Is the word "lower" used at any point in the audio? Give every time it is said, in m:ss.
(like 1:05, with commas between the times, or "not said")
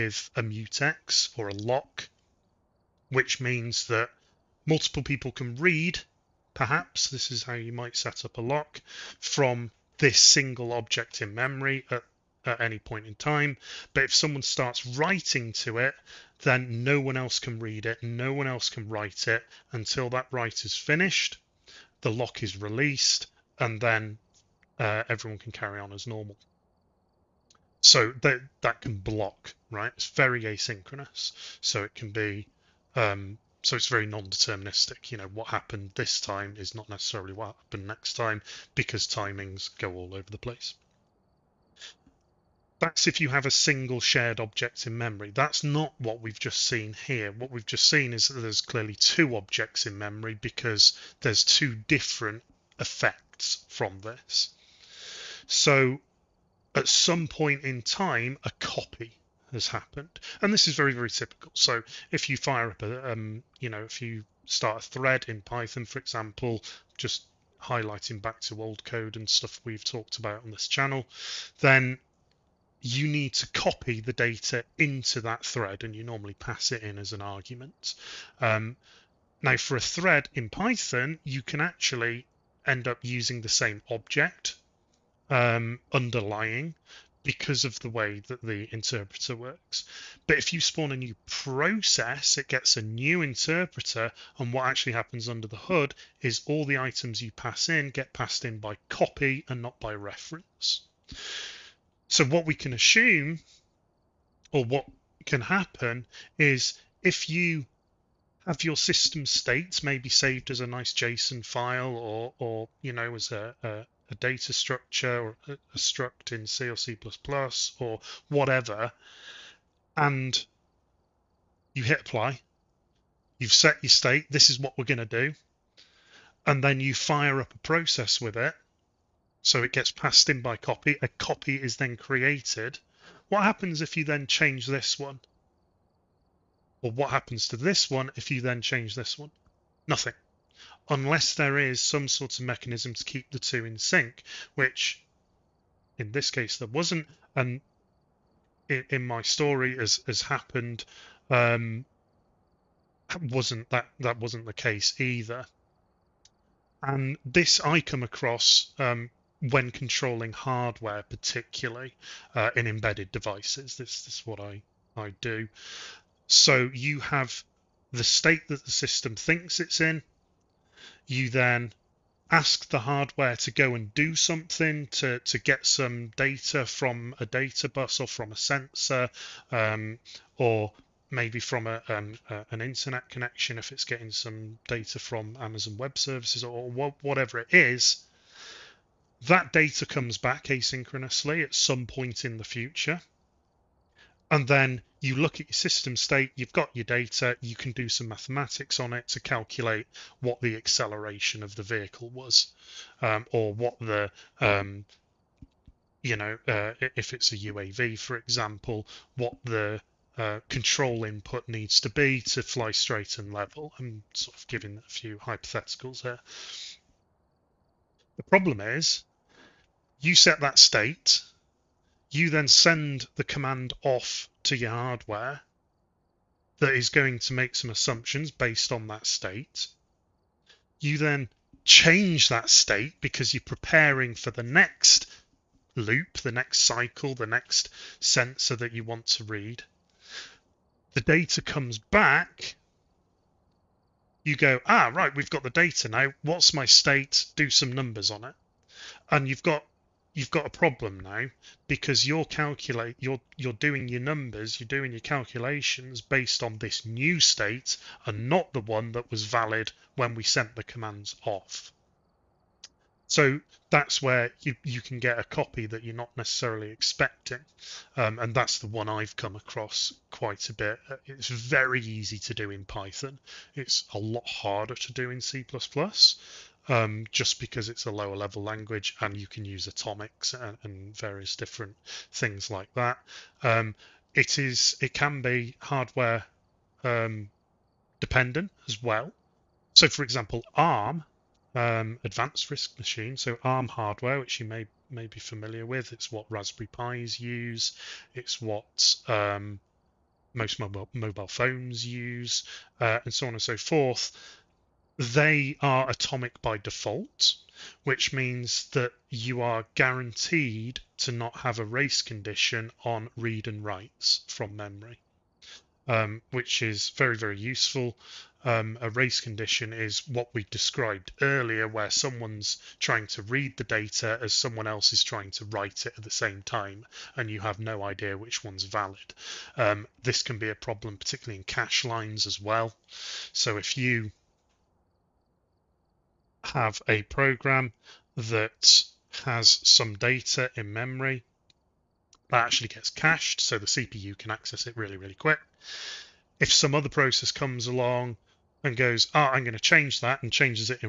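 4:37.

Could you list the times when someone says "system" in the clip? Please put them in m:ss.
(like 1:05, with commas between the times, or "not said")
1:48, 2:48, 3:15.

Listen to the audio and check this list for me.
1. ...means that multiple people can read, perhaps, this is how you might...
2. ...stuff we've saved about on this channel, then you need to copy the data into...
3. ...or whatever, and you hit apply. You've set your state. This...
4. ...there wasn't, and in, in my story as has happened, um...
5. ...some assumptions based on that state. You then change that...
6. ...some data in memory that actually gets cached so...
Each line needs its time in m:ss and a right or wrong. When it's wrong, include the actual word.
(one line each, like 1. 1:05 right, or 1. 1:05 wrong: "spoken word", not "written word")
1. 0:03 right
2. 1:09 wrong: "talked", not "saved"
3. 1:57 right
4. 2:26 right
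5. 3:47 right
6. 5:39 right.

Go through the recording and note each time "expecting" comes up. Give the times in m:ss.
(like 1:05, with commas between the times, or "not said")
4:26.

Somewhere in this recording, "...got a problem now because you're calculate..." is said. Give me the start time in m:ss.
4:10.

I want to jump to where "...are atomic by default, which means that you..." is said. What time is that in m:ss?
5:05.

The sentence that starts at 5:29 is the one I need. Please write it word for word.
Um, this can be a problem, particularly in cache lines as well.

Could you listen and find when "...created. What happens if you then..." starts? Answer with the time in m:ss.
2:11.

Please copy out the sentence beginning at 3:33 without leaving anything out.
I'm sort of giving a few hypotheticals here.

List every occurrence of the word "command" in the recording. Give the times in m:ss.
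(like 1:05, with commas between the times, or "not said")
3:43, 4:20.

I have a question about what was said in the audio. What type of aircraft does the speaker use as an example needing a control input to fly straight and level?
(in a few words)
UAV.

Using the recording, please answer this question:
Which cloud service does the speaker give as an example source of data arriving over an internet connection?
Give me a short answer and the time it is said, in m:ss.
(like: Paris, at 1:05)
Amazon Web Services, at 3:05.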